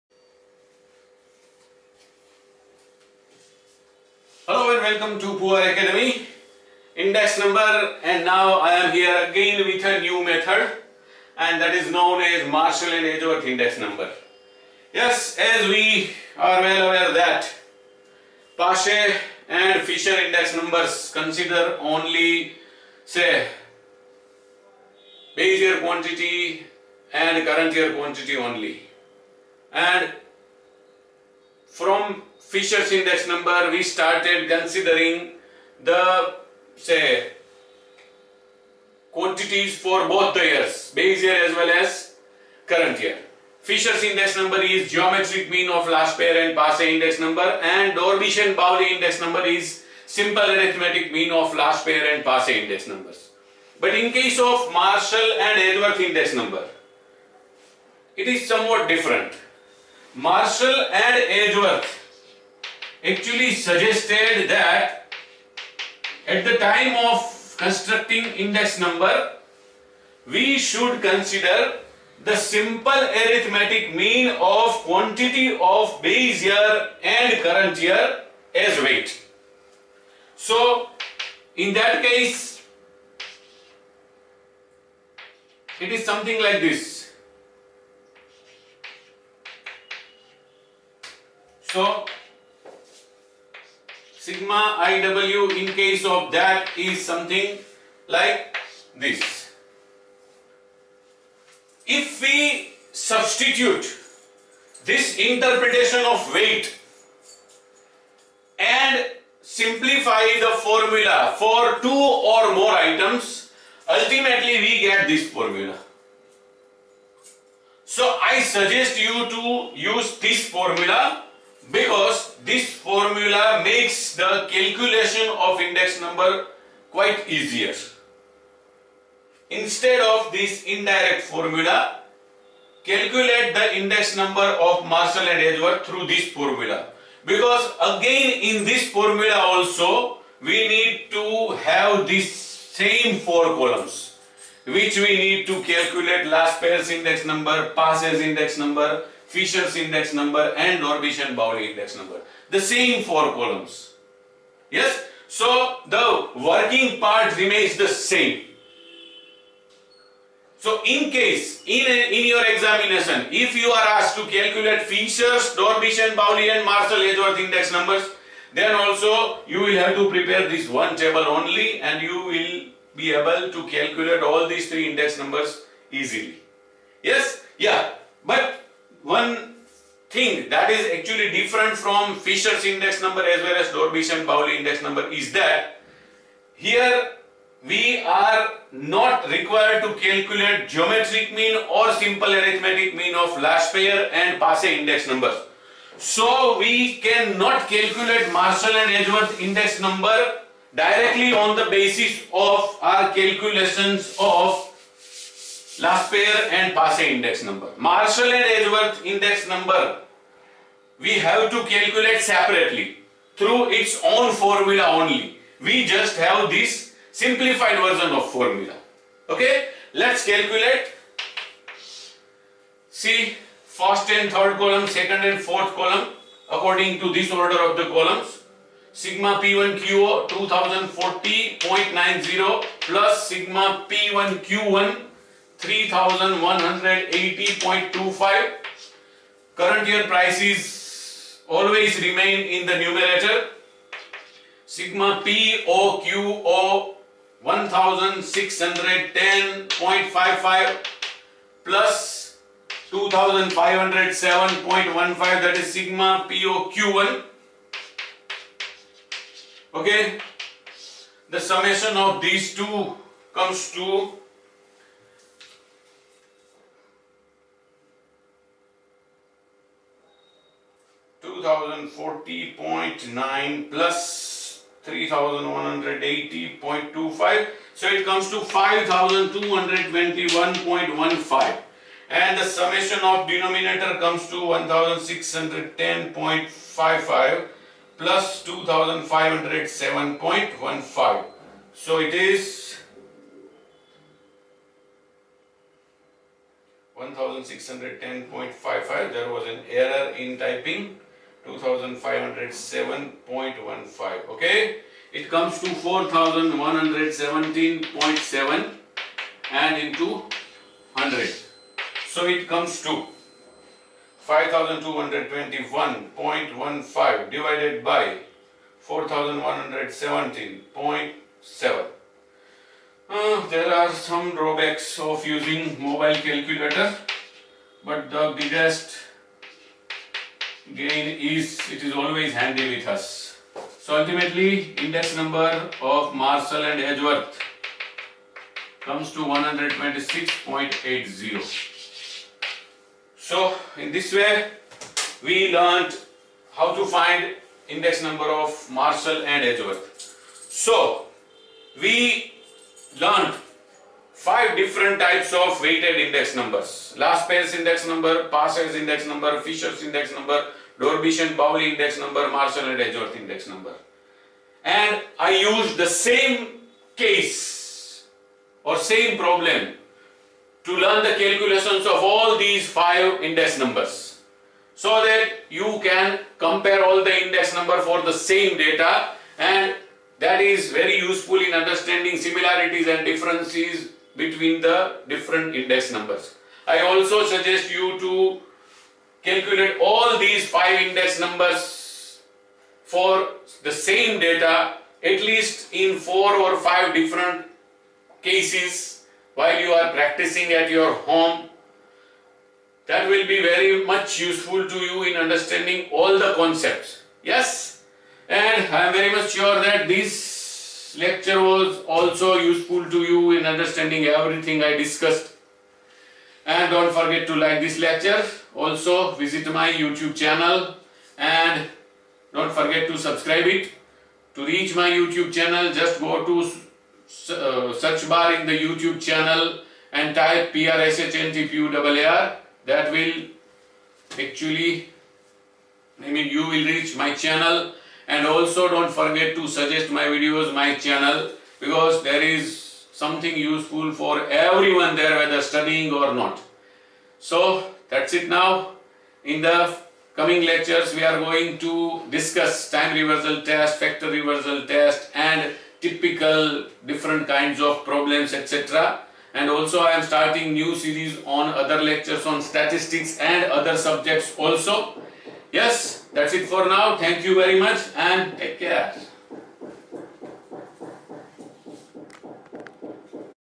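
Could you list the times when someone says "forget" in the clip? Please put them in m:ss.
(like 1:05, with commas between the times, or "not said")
6:56, 7:02, 7:18.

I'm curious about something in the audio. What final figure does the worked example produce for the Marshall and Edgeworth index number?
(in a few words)
126.80.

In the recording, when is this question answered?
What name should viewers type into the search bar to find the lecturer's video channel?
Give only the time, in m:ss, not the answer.
7:10.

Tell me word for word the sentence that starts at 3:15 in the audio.
So we cannot calculate Marshall and Edgeworth index number directly on the basis of our calculations of Laspeyres and Paasche index number.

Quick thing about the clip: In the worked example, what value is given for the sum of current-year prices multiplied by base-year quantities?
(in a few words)
2040.90.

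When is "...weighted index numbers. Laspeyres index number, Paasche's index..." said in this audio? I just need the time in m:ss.
5:55.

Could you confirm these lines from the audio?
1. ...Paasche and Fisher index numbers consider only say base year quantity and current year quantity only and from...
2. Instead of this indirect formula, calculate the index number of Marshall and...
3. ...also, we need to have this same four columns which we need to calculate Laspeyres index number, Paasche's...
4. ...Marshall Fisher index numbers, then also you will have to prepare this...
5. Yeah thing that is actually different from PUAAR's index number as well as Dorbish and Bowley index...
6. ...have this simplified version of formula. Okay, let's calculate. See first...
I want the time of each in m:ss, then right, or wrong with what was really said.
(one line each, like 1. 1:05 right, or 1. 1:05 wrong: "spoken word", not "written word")
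1. 0:18 right
2. 2:09 right
3. 2:19 right
4. 2:46 wrong: "Edgeworth", not "Fisher"
5. 2:57 wrong: "Fisher", not "PUAAR"
6. 3:36 right.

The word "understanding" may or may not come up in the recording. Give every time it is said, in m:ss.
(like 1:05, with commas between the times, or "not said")
6:21, 6:45, 6:53.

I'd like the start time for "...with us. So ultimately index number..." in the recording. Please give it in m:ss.
5:32.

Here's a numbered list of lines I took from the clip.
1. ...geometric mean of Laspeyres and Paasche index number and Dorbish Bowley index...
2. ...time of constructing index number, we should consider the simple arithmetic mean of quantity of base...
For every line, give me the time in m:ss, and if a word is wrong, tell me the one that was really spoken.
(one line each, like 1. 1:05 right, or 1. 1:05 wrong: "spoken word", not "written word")
1. 0:44 right
2. 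1:06 right.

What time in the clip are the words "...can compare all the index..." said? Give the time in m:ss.
6:15.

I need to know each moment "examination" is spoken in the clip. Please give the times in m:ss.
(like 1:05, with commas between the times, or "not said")
2:42.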